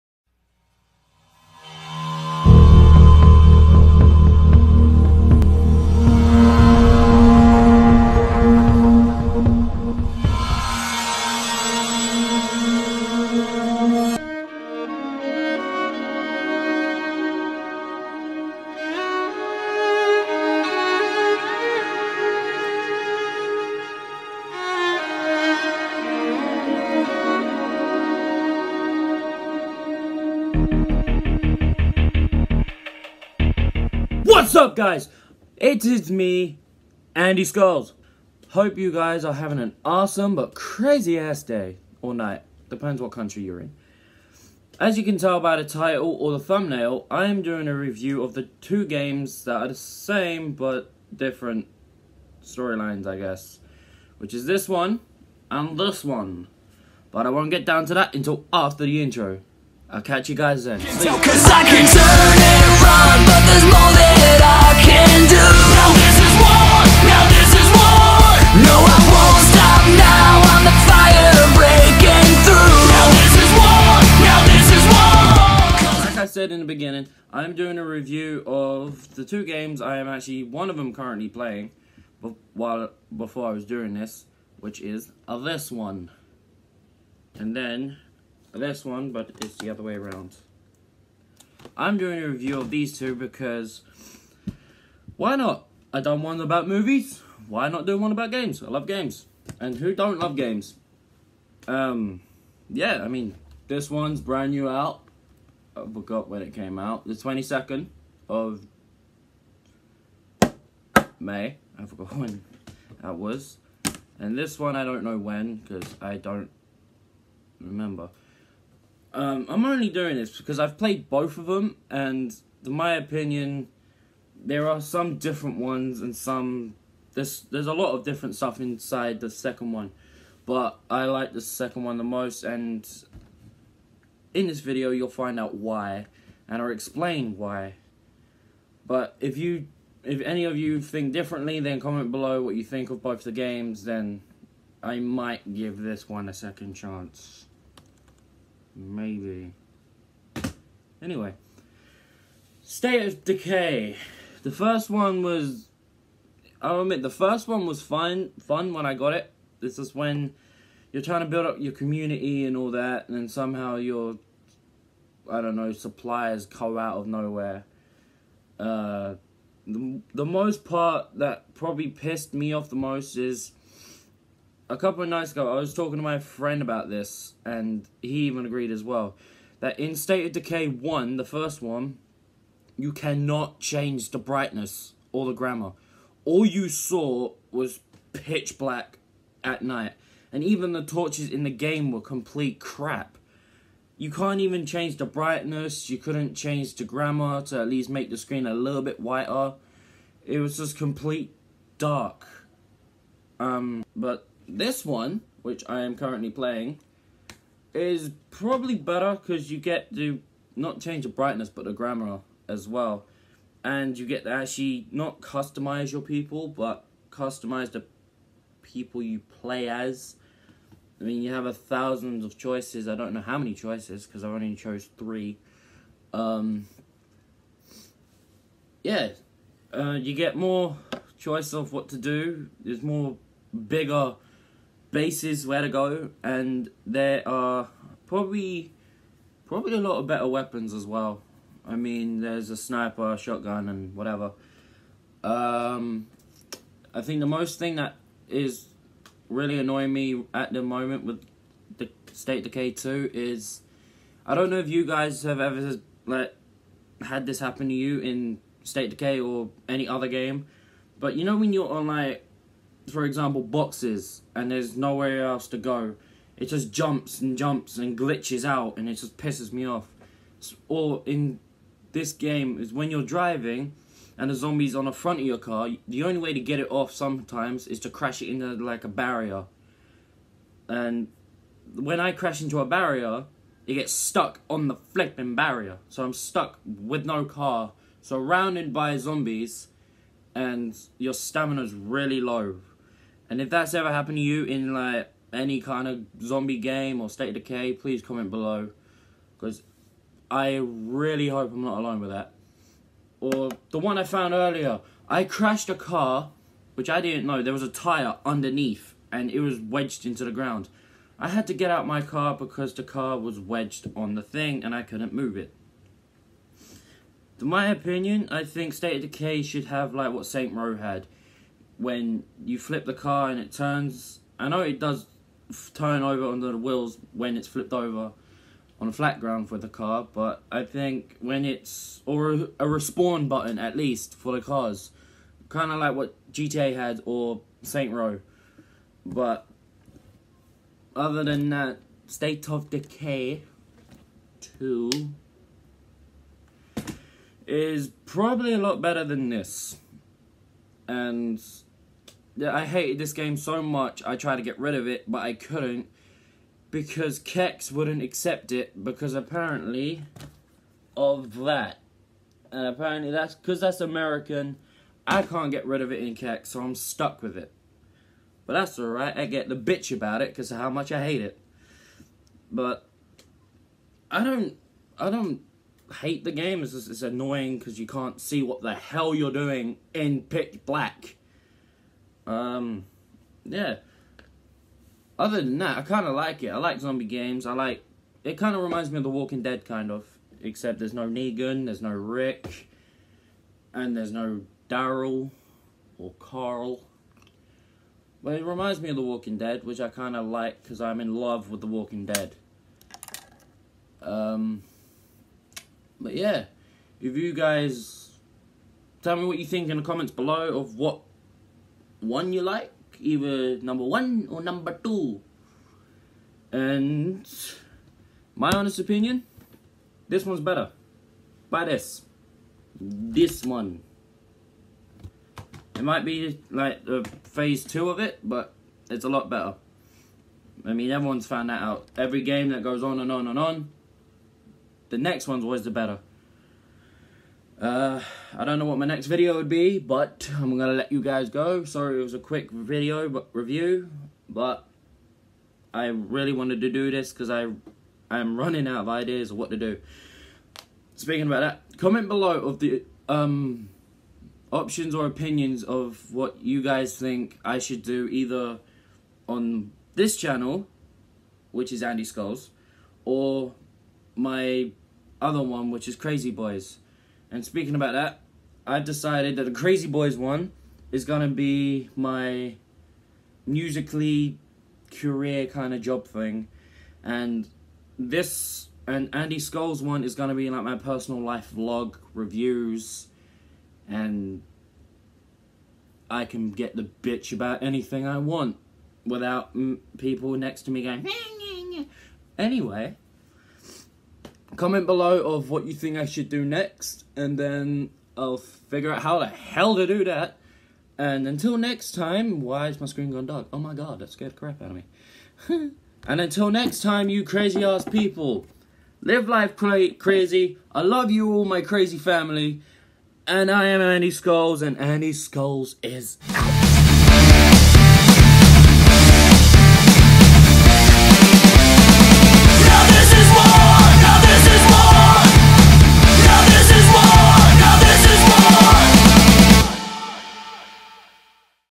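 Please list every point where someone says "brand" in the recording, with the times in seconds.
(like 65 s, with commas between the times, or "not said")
104 s.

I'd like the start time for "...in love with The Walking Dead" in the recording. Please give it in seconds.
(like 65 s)
401 s.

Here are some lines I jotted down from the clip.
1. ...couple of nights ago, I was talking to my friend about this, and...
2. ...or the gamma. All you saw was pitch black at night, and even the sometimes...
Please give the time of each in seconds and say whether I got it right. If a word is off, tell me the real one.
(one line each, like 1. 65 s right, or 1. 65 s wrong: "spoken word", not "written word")
1. 174 s right
2. 185 s wrong: "torches", not "sometimes".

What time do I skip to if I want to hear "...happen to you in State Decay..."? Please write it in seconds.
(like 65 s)
257 s.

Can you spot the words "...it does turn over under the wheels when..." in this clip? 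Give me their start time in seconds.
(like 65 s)
324 s.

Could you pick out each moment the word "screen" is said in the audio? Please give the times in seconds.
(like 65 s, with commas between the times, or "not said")
198 s, 502 s.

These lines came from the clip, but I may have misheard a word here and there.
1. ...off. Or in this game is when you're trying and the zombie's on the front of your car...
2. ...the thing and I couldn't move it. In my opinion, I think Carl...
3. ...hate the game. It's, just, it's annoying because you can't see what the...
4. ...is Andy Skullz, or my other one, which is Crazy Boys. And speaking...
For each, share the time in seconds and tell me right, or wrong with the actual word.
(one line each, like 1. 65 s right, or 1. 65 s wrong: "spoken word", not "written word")
1. 269 s wrong: "driving", not "trying"
2. 314 s wrong: "State", not "Carl"
3. 376 s right
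4. 461 s right.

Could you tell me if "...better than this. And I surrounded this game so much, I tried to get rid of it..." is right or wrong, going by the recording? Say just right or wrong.
wrong.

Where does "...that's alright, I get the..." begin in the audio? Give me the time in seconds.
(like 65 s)
368 s.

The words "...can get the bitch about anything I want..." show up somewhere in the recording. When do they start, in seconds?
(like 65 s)
486 s.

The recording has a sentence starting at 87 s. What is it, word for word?
And then this one, but it's the other way around.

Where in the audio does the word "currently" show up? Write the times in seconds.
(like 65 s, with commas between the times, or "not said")
80 s, 205 s.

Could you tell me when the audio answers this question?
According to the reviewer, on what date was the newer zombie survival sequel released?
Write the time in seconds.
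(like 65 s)
107 s.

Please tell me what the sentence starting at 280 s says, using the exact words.
And when I crash into a barrier, it gets stuck on the flipping barrier.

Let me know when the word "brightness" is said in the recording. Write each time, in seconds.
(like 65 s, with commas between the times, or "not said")
184 s, 195 s, 211 s.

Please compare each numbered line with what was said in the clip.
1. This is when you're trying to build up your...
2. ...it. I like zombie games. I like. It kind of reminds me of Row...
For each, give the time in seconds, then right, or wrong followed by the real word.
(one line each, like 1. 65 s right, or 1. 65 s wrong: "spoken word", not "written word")
1. 159 s right
2. 386 s wrong: "The", not "Row".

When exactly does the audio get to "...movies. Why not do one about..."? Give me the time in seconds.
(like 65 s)
96 s.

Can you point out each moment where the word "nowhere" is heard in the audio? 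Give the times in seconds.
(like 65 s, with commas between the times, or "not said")
167 s, 264 s.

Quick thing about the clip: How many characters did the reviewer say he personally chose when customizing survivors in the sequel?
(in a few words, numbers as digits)
3.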